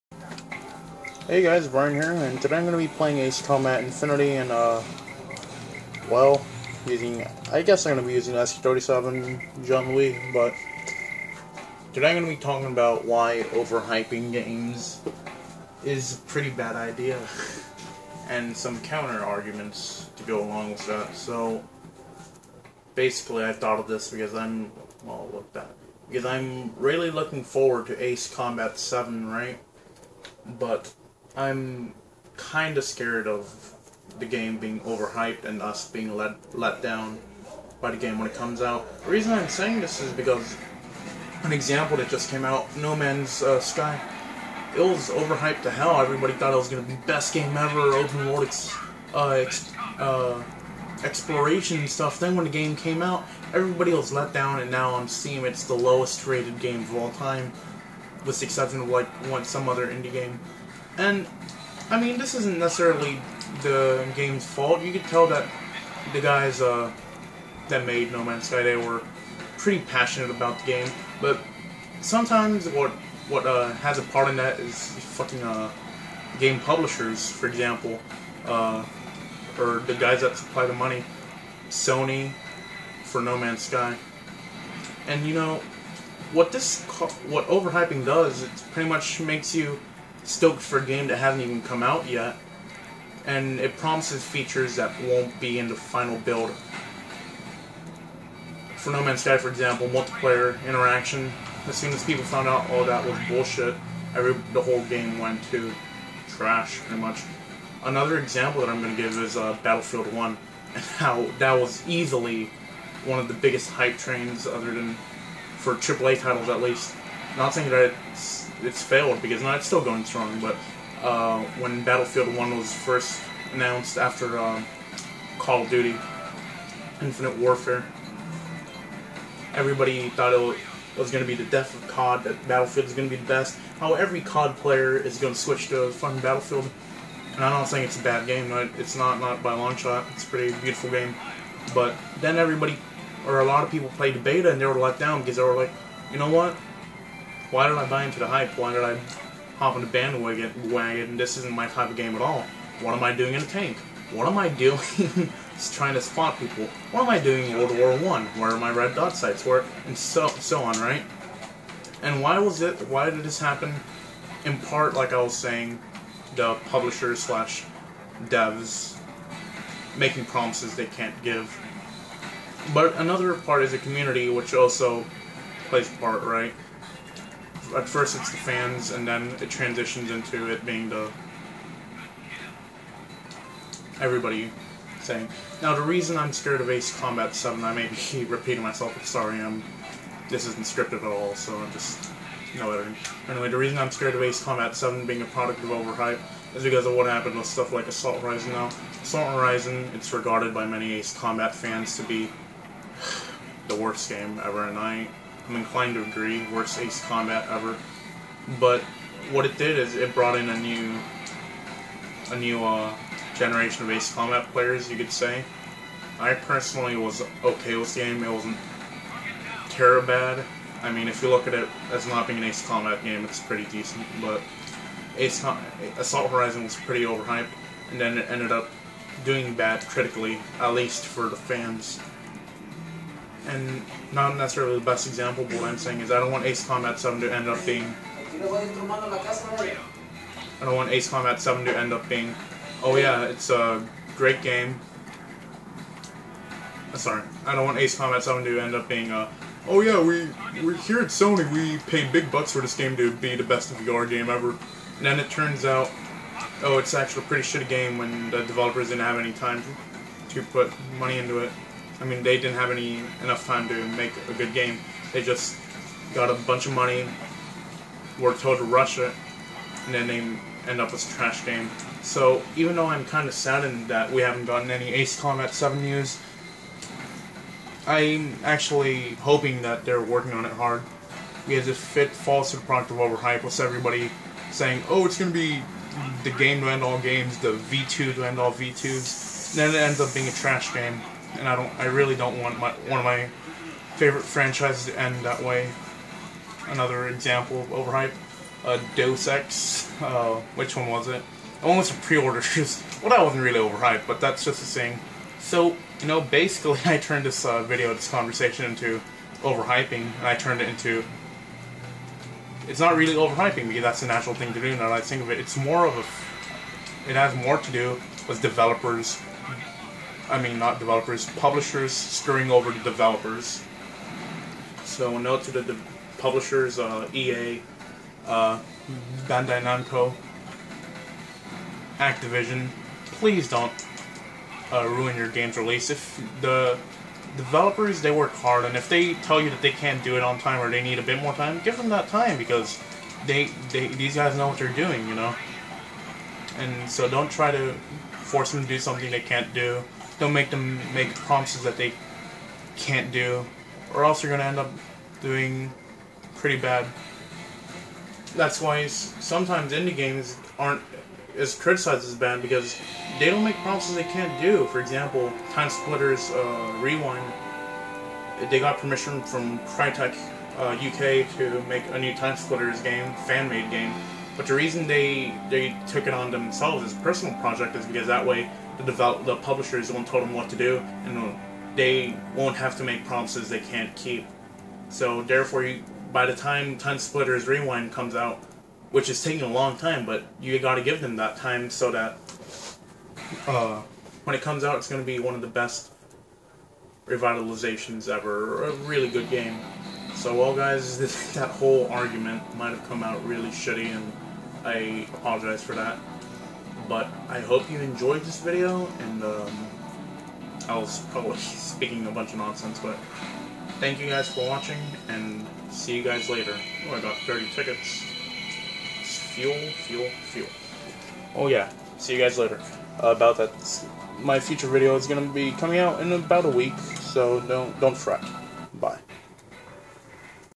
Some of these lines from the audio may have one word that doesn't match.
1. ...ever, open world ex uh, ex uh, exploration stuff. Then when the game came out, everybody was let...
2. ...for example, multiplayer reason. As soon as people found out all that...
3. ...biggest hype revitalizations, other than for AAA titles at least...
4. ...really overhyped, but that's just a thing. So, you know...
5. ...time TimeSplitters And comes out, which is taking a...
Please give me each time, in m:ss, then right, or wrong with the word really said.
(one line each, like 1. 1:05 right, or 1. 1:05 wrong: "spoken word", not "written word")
1. 0:47 right
2. 1:39 wrong: "interaction", not "reason"
3. 1:53 wrong: "trains", not "revitalizations"
4. 5:03 right
5. 6:26 wrong: "Rewind", not "And".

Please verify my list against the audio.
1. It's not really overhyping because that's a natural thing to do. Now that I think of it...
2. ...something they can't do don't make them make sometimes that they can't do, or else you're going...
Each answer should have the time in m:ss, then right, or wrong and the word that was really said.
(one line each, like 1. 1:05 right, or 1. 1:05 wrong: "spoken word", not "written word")
1. 5:12 right
2. 5:48 wrong: "promises", not "sometimes".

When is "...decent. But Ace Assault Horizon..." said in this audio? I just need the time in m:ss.
3:43.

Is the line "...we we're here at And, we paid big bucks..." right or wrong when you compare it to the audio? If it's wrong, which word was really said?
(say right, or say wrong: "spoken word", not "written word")
wrong: "Sony", not "And".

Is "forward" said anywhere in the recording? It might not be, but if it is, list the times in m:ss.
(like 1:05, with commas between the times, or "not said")
0:27.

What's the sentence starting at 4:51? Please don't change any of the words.
I really don't want my one of my favorite franchises to end that way.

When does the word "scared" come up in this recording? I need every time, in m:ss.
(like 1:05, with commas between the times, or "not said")
0:32, 3:06, 3:13.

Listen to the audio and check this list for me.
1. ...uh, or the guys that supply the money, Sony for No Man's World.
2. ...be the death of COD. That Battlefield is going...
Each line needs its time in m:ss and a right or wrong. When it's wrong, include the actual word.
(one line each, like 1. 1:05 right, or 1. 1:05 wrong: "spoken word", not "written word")
1. 1:18 wrong: "Sky", not "World"
2. 2:11 right.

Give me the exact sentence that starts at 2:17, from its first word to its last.
And I'm not saying it's a bad game.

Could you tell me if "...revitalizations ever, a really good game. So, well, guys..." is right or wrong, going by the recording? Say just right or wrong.
right.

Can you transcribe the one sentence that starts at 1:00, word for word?
And, I mean, this isn't necessarily the game's fault.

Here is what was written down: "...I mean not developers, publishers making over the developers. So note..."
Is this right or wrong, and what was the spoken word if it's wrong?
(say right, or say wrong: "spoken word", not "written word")
wrong: "screwing", not "making".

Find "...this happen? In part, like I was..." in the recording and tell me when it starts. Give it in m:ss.
2:43.